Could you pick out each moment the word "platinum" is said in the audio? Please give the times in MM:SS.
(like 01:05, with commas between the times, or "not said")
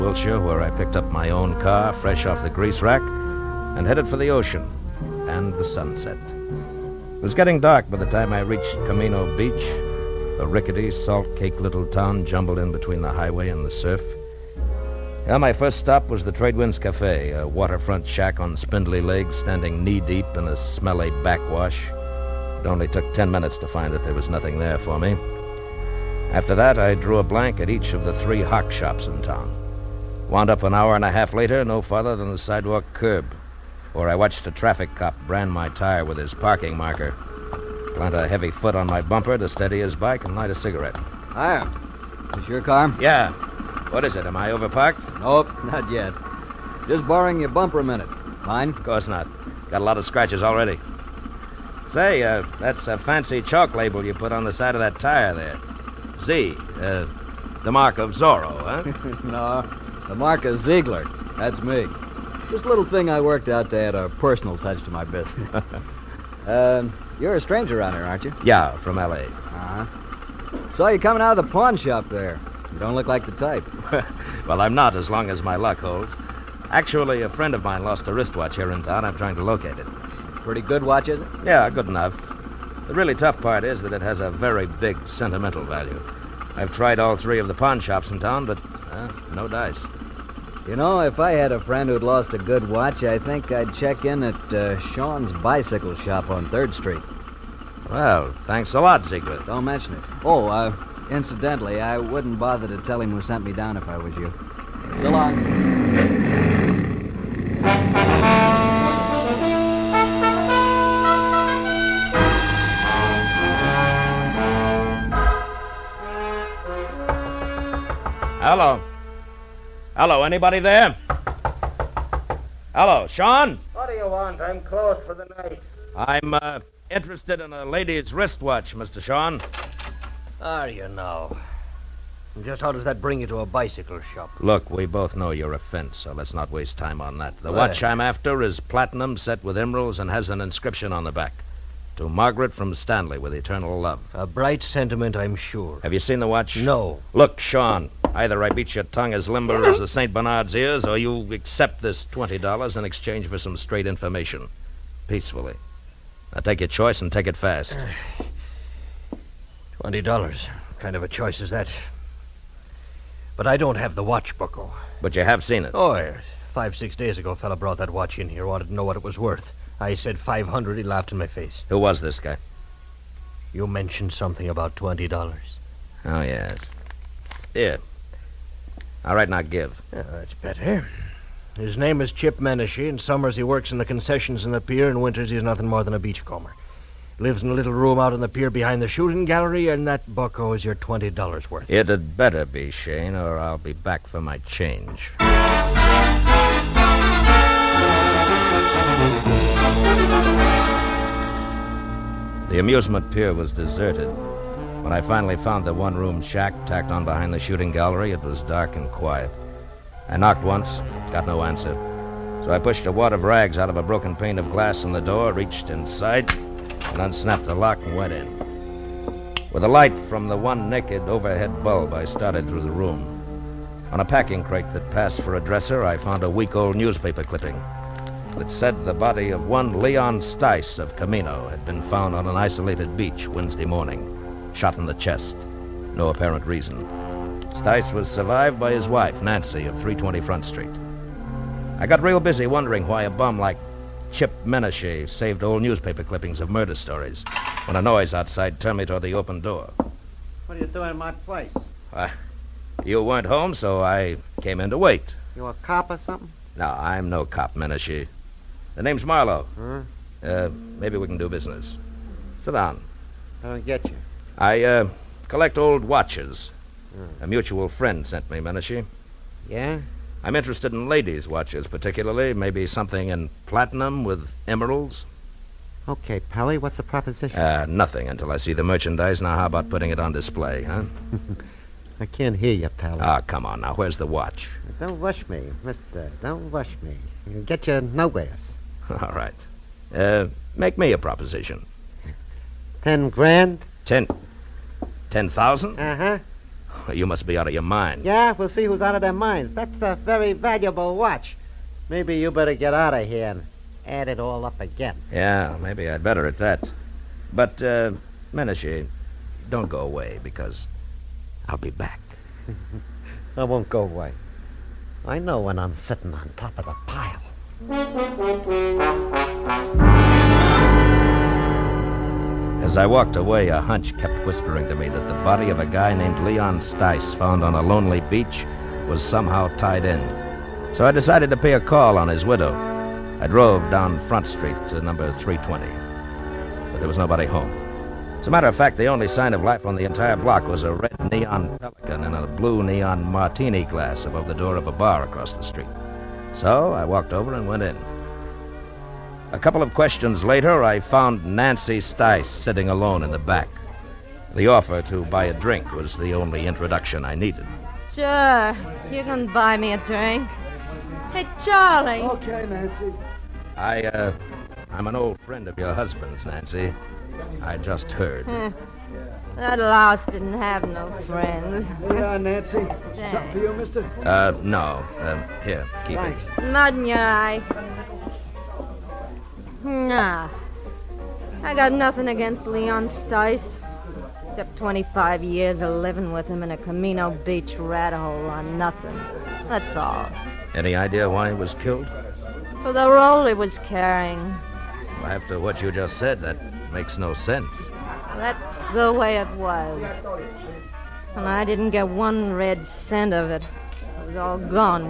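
02:18, 04:33.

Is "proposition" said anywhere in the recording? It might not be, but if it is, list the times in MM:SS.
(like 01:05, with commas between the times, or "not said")
04:36, 04:50.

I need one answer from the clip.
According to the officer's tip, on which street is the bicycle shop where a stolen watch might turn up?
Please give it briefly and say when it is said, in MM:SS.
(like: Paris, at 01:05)
3rd Street, at 01:36.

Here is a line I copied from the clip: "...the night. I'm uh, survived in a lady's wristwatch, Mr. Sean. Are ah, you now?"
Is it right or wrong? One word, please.
wrong.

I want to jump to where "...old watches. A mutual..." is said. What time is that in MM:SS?
04:25.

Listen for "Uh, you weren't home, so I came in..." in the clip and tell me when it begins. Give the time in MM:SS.
04:11.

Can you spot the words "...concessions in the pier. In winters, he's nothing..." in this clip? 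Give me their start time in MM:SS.
03:03.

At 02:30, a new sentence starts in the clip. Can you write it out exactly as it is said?
Bernard's ears, or you accept this $20 in exchange for some straight information.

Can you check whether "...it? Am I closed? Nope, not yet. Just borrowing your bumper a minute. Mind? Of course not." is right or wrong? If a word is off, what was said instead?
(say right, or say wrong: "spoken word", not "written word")
wrong: "overparked", not "closed".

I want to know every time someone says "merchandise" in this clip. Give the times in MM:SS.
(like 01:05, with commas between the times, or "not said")
04:38.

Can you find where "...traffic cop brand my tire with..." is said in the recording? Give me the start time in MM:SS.
00:34.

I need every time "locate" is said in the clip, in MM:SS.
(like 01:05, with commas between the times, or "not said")
01:19.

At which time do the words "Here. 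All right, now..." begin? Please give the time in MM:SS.
02:57.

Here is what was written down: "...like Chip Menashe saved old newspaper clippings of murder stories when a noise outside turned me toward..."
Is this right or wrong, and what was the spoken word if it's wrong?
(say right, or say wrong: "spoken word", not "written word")
right.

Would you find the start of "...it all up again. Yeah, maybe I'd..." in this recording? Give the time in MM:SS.
05:04.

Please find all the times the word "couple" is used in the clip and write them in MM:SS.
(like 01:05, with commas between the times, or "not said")
05:49.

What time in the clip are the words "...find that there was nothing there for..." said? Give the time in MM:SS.
00:23.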